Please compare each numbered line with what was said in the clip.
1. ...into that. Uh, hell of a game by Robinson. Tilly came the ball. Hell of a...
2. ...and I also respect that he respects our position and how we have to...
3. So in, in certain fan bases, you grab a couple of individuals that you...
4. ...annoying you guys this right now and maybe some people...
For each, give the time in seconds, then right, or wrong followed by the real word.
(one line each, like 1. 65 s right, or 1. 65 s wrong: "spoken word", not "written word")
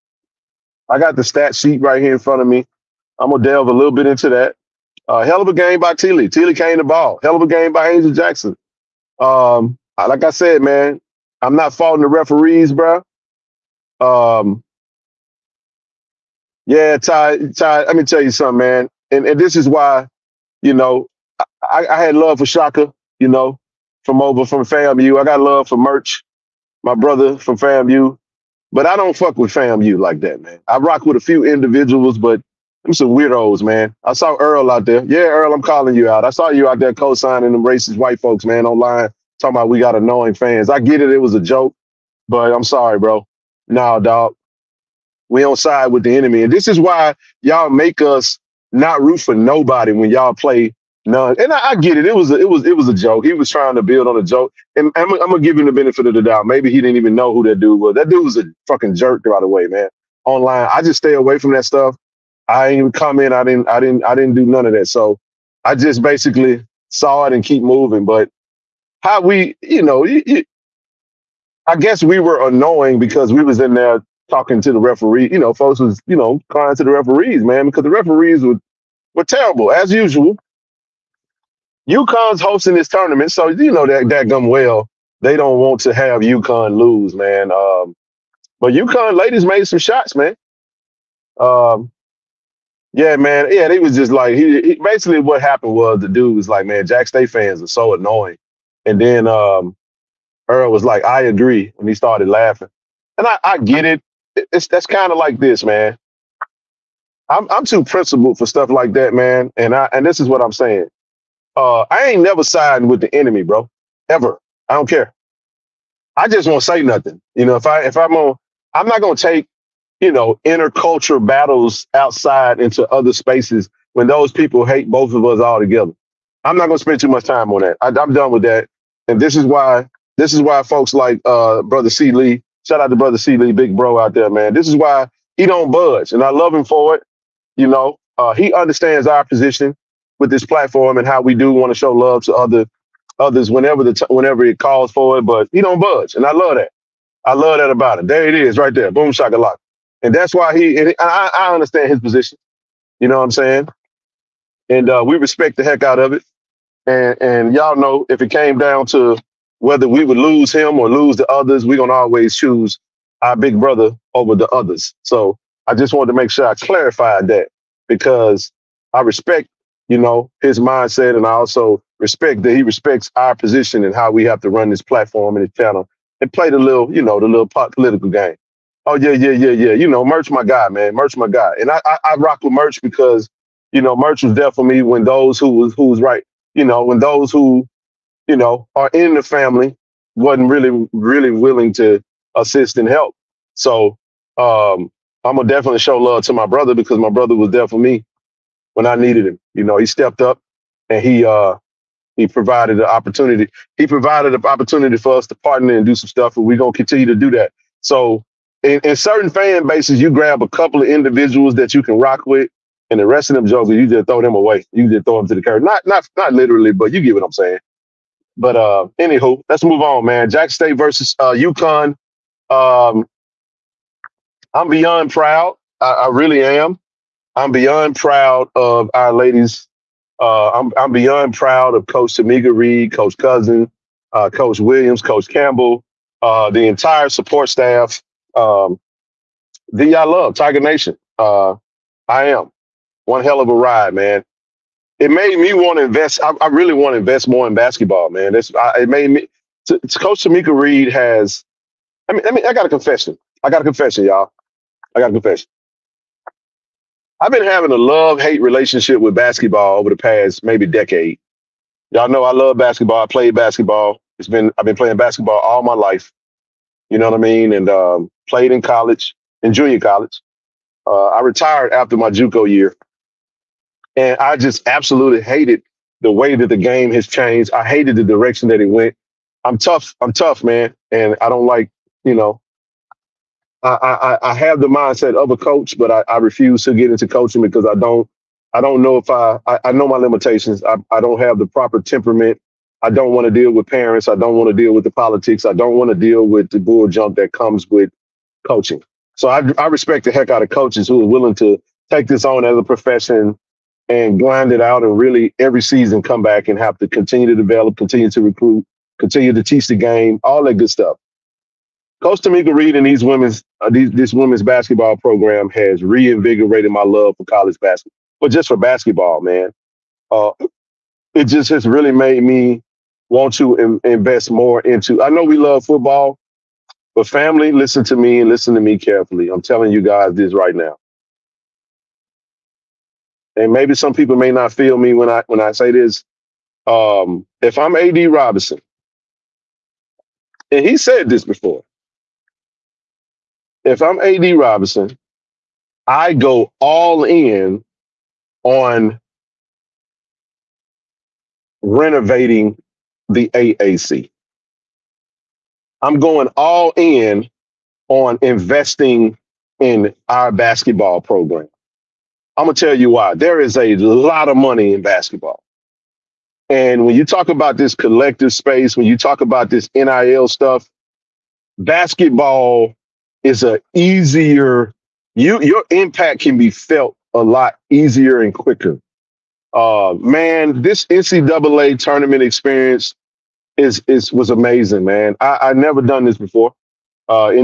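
1. 4 s wrong: "Tilly", not "Robinson"
2. 171 s right
3. 207 s right
4. 329 s wrong: "telling", not "annoying".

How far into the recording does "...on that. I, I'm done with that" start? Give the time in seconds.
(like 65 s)
127 s.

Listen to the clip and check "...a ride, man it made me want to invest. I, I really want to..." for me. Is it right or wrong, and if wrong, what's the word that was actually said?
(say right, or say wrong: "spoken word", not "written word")
right.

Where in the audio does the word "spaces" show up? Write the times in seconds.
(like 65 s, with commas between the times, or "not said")
123 s, 368 s.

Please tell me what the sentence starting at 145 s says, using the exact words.
But he don't budge, and I love that.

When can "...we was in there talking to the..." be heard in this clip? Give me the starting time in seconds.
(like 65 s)
73 s.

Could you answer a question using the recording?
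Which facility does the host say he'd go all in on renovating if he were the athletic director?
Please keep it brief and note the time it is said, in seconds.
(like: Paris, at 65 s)
The AAC, at 353 s.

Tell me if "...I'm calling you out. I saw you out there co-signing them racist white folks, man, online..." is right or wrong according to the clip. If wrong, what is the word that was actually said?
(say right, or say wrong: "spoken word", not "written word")
right.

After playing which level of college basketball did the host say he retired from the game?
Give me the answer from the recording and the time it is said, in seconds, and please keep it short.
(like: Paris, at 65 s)
Junior college, at 269 s.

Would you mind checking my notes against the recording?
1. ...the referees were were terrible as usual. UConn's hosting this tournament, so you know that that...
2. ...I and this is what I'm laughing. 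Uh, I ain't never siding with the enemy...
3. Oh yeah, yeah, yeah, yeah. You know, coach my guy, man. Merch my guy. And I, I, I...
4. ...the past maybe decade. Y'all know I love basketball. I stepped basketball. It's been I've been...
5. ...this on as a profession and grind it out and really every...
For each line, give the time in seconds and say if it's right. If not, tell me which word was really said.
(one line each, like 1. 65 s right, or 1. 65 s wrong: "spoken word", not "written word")
1. 77 s right
2. 109 s wrong: "saying", not "laughing"
3. 178 s wrong: "merch", not "coach"
4. 259 s wrong: "played", not "stepped"
5. 302 s right.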